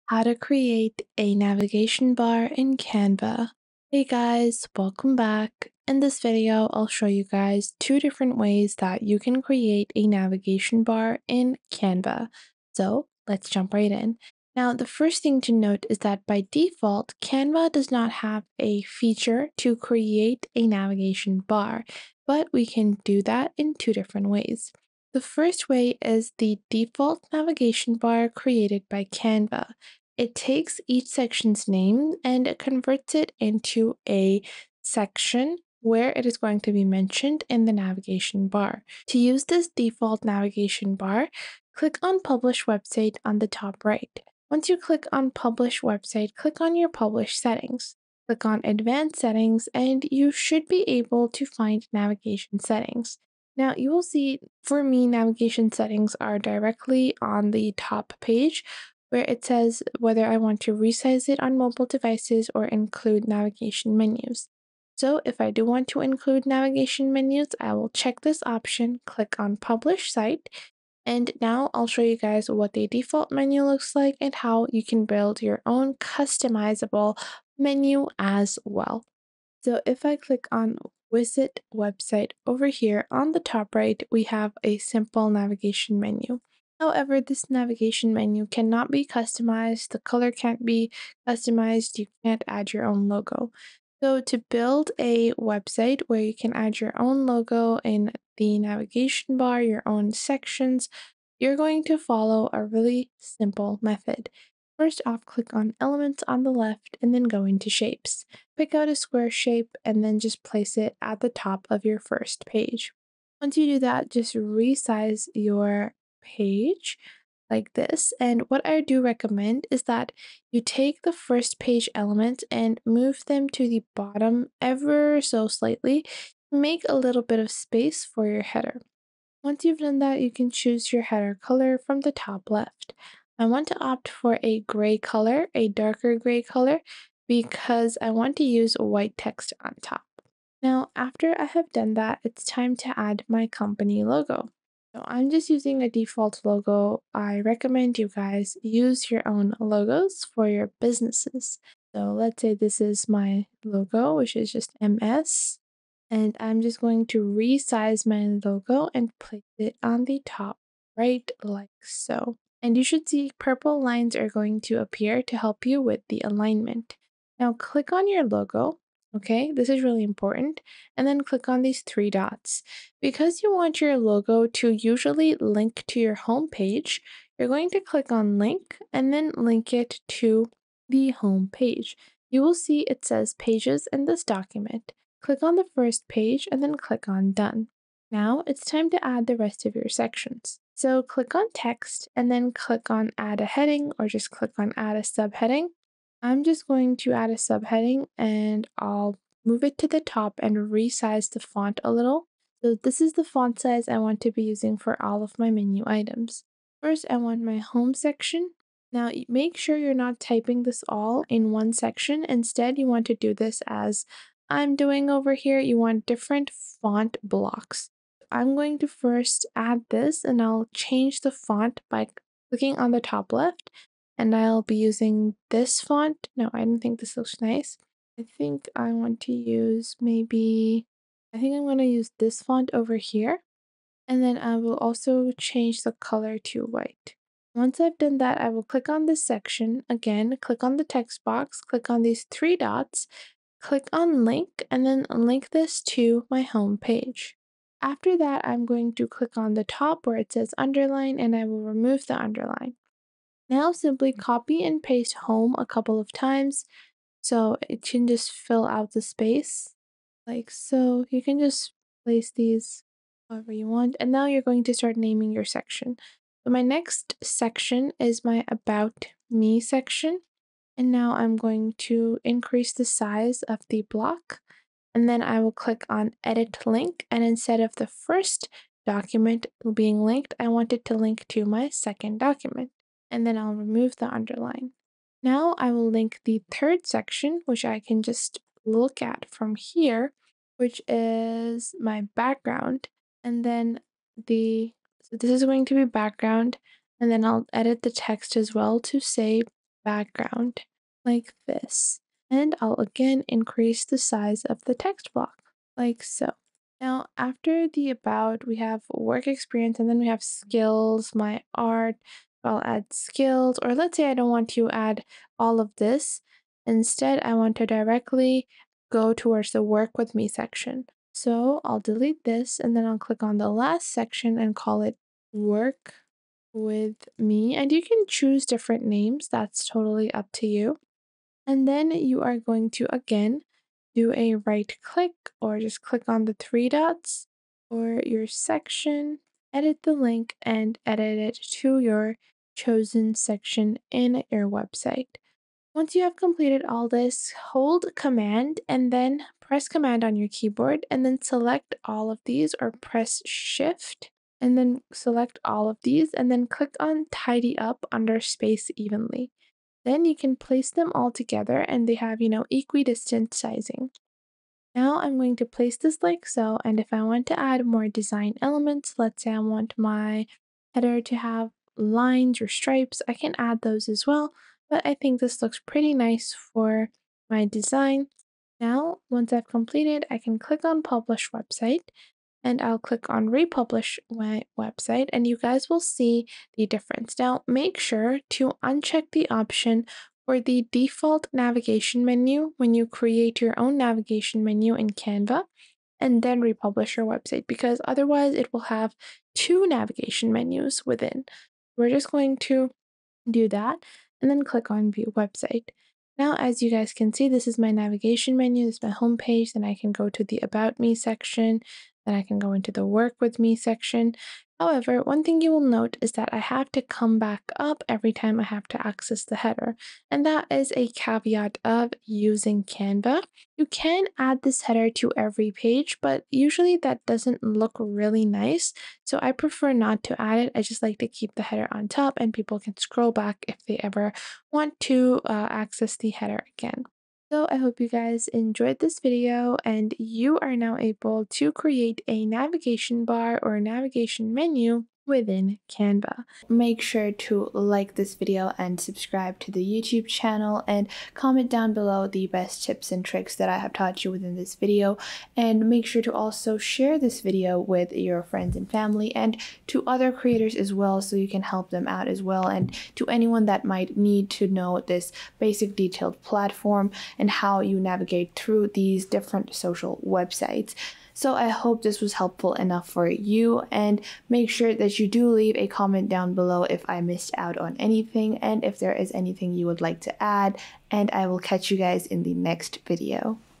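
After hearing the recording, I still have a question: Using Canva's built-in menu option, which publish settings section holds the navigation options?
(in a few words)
Advanced Settings.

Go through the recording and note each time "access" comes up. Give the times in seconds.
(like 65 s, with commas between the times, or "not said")
418 s, 435 s.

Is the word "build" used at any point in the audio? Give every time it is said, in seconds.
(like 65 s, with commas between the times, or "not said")
75 s, 94 s.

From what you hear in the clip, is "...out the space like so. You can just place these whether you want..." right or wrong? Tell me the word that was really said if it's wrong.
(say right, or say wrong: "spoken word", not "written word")
wrong: "however", not "whether".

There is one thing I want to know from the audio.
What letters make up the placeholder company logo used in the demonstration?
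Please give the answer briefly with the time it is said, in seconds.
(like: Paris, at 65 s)
MS, at 154 s.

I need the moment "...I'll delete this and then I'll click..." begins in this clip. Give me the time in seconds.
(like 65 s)
321 s.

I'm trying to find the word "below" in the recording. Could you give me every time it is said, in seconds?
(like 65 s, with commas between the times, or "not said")
451 s, 476 s.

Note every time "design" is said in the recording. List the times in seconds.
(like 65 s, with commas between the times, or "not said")
367 s, 377 s.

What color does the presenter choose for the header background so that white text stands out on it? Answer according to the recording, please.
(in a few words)
Darker gray.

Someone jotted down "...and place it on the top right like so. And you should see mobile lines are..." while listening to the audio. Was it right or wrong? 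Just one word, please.
wrong.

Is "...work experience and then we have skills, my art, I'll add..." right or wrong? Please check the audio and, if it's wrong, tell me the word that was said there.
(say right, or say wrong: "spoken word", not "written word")
right.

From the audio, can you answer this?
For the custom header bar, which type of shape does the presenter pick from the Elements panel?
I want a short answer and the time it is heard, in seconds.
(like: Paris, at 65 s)
Square, at 108 s.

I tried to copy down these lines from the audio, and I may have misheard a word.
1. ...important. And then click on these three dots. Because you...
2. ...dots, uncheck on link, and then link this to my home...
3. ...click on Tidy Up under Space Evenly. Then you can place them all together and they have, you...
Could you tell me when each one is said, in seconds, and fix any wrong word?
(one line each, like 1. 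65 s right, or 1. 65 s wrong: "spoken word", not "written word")
1. 170 s right
2. 242 s wrong: "click", not "uncheck"
3. 356 s right.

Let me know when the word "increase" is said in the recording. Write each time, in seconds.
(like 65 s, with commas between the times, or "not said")
272 s, 303 s.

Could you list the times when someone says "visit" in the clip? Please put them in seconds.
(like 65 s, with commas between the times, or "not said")
81 s.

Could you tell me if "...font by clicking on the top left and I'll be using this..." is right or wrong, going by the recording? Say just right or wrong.
right.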